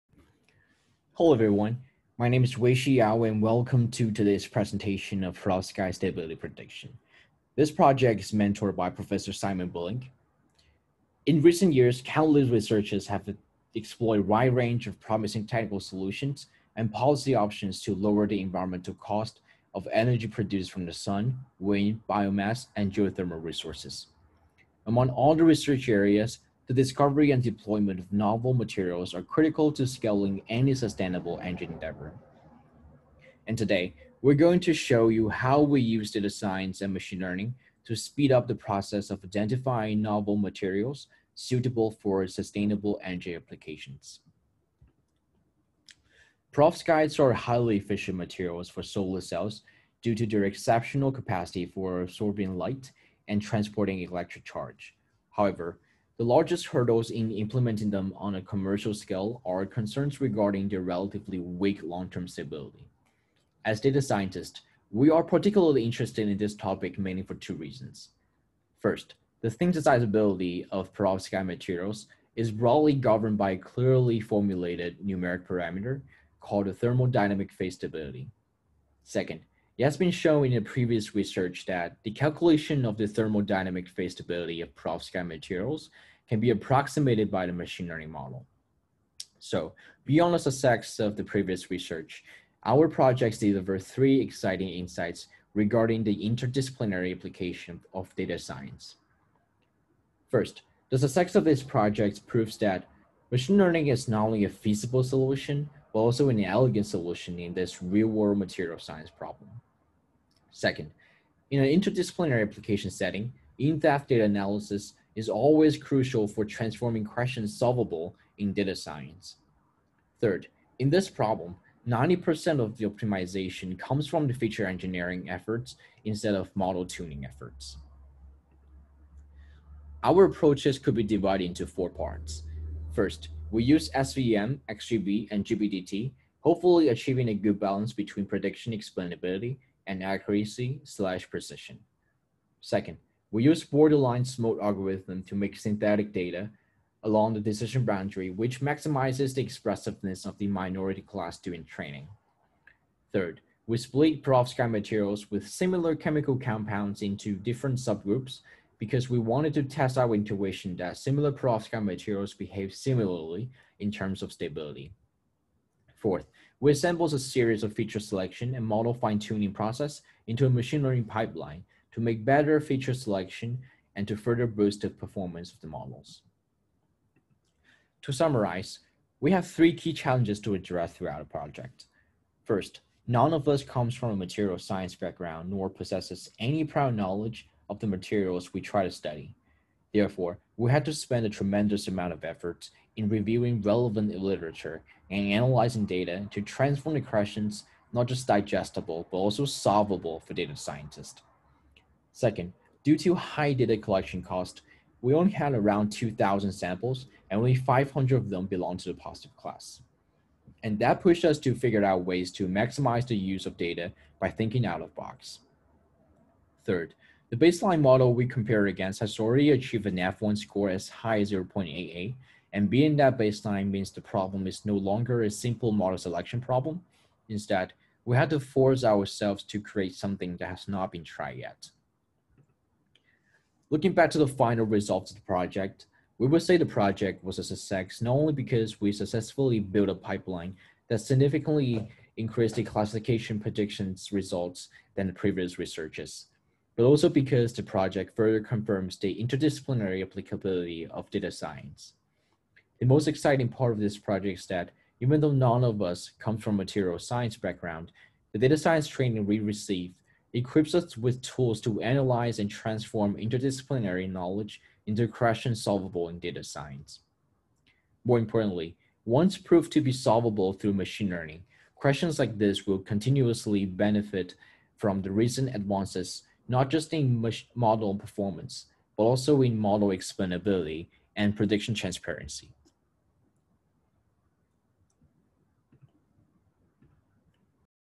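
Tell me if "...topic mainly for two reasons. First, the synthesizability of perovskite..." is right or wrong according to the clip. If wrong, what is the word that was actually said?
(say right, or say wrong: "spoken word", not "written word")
right.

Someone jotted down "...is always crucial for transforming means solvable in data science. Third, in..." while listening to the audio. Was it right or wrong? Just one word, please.
wrong.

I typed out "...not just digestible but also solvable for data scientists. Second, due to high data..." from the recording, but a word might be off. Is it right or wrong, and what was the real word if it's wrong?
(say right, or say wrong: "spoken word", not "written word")
right.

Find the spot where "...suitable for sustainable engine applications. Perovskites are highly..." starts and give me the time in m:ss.
0:41.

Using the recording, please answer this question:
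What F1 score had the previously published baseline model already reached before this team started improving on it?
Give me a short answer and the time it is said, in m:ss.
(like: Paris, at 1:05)
0.88, at 3:41.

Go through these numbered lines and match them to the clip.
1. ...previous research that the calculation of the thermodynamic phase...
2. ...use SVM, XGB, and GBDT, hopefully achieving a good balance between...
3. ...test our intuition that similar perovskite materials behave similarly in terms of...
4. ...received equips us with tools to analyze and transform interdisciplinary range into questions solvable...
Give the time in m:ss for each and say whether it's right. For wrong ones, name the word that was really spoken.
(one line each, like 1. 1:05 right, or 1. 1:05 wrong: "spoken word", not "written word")
1. 1:20 right
2. 2:13 right
3. 2:39 right
4. 4:19 wrong: "knowledge", not "range".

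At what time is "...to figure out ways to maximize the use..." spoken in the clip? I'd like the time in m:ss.
3:31.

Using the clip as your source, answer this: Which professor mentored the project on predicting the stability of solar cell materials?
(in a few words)
Simon Billinge.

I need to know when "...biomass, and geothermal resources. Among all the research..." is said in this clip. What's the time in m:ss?
0:22.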